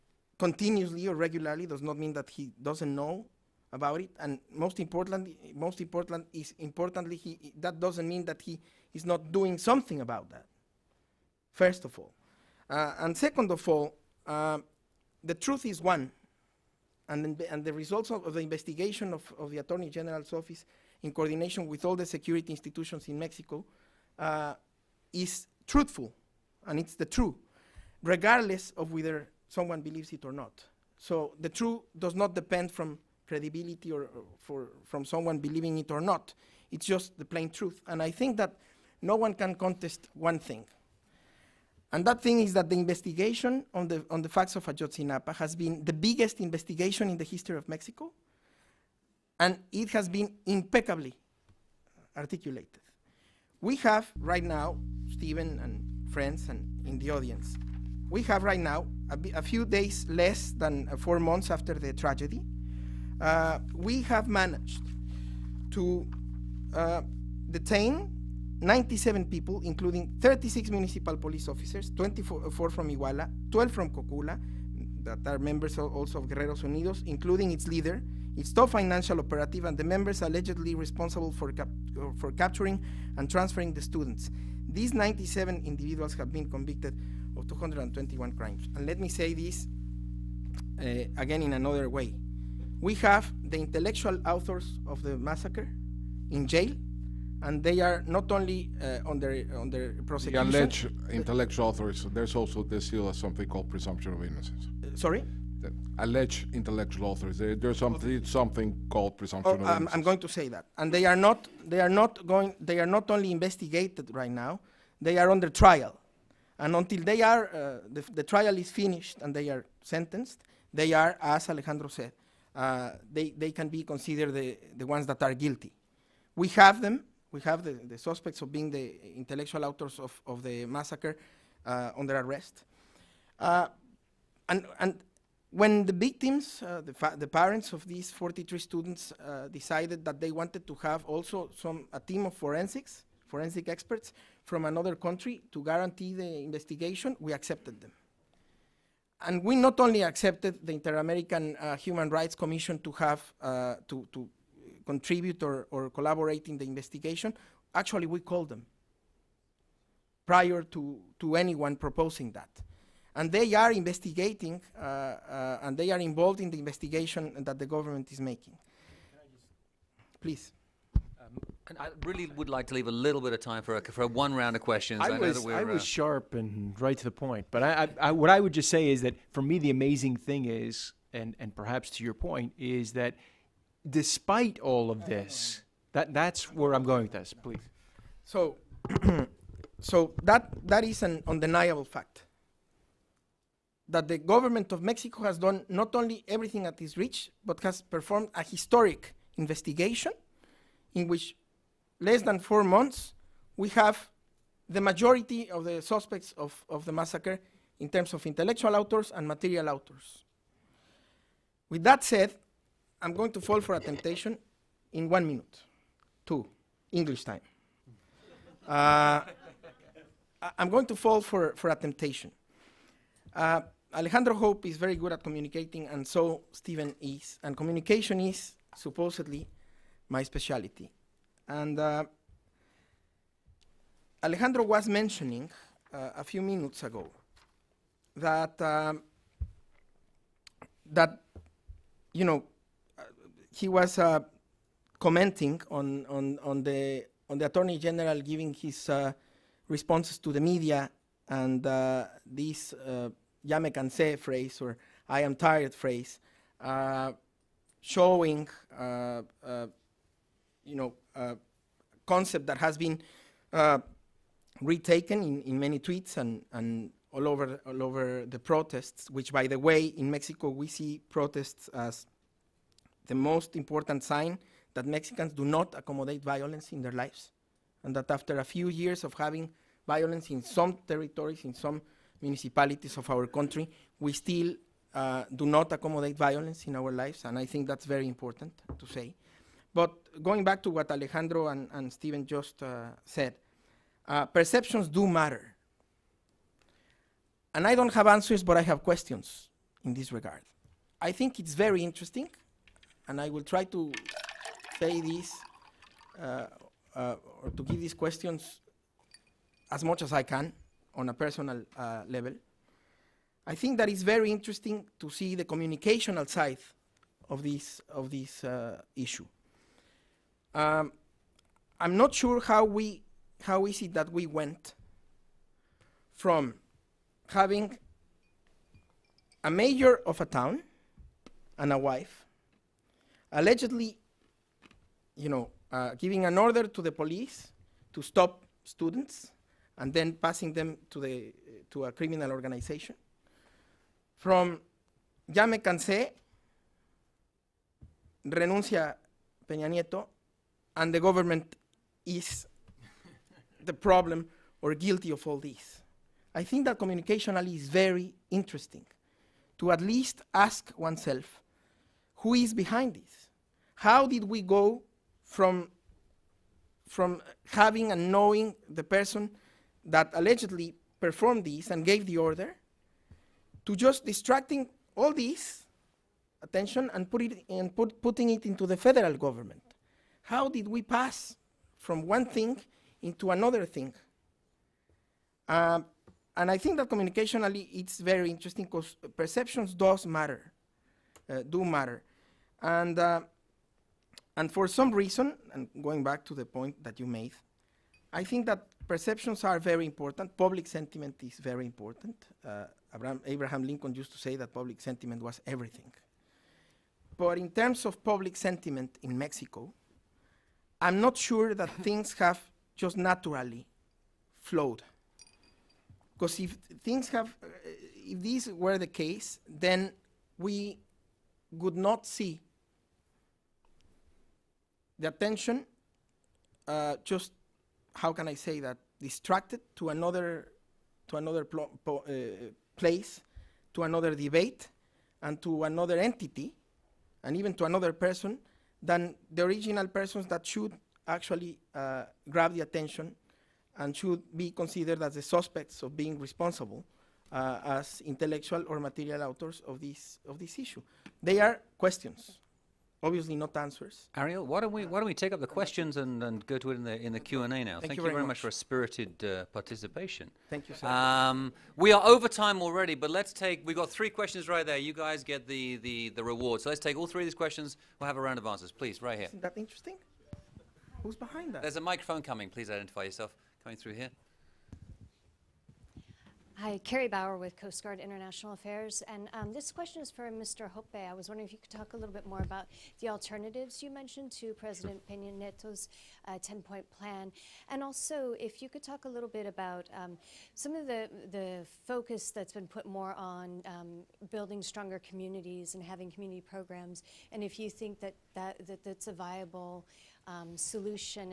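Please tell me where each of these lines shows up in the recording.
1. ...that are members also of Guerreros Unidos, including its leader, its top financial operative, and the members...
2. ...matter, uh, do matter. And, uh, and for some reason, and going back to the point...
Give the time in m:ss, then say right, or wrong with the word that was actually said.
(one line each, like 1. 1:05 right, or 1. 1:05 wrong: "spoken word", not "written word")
1. 1:15 right
2. 6:30 right.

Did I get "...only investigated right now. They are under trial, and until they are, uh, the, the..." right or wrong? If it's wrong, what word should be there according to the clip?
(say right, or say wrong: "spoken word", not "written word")
right.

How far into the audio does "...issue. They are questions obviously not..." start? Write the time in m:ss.
7:30.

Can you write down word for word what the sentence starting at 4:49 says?
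But going back to what Alejandro and, and Steven just uh, said, uh, perceptions do matter.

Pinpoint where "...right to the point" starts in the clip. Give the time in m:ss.
2:56.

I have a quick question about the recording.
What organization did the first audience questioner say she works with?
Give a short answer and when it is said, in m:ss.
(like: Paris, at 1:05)
Coast Guard International Affairs, at 7:57.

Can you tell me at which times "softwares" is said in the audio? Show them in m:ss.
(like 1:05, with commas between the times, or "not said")
not said.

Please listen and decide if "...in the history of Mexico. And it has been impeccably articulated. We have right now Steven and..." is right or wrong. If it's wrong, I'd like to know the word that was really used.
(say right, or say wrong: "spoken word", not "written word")
right.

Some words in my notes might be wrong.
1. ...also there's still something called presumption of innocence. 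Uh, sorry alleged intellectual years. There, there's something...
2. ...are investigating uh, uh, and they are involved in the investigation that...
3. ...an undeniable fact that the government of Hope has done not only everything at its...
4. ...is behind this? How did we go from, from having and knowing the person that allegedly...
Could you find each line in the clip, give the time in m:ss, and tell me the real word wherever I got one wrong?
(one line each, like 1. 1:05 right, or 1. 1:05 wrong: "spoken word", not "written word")
1. 1:42 wrong: "authors", not "years"
2. 2:43 right
3. 3:11 wrong: "Mexico", not "Hope"
4. 6:02 right.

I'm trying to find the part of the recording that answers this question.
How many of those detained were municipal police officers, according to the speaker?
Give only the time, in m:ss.
1:10.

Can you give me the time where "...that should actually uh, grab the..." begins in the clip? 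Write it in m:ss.
7:20.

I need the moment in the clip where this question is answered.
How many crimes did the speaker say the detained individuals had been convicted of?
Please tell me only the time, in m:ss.
1:27.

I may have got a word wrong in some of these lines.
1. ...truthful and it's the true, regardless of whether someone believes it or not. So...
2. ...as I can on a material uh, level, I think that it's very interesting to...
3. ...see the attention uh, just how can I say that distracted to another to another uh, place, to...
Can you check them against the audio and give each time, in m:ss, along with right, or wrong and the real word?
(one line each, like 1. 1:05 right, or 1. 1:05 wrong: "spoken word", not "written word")
1. 0:25 right
2. 5:10 wrong: "personal", not "material"
3. 7:02 right.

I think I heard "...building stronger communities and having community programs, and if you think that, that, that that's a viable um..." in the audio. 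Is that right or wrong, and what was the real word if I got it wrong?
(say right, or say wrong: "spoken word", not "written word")
right.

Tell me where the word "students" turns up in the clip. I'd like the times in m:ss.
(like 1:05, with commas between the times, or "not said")
1:23, 2:18, 5:38.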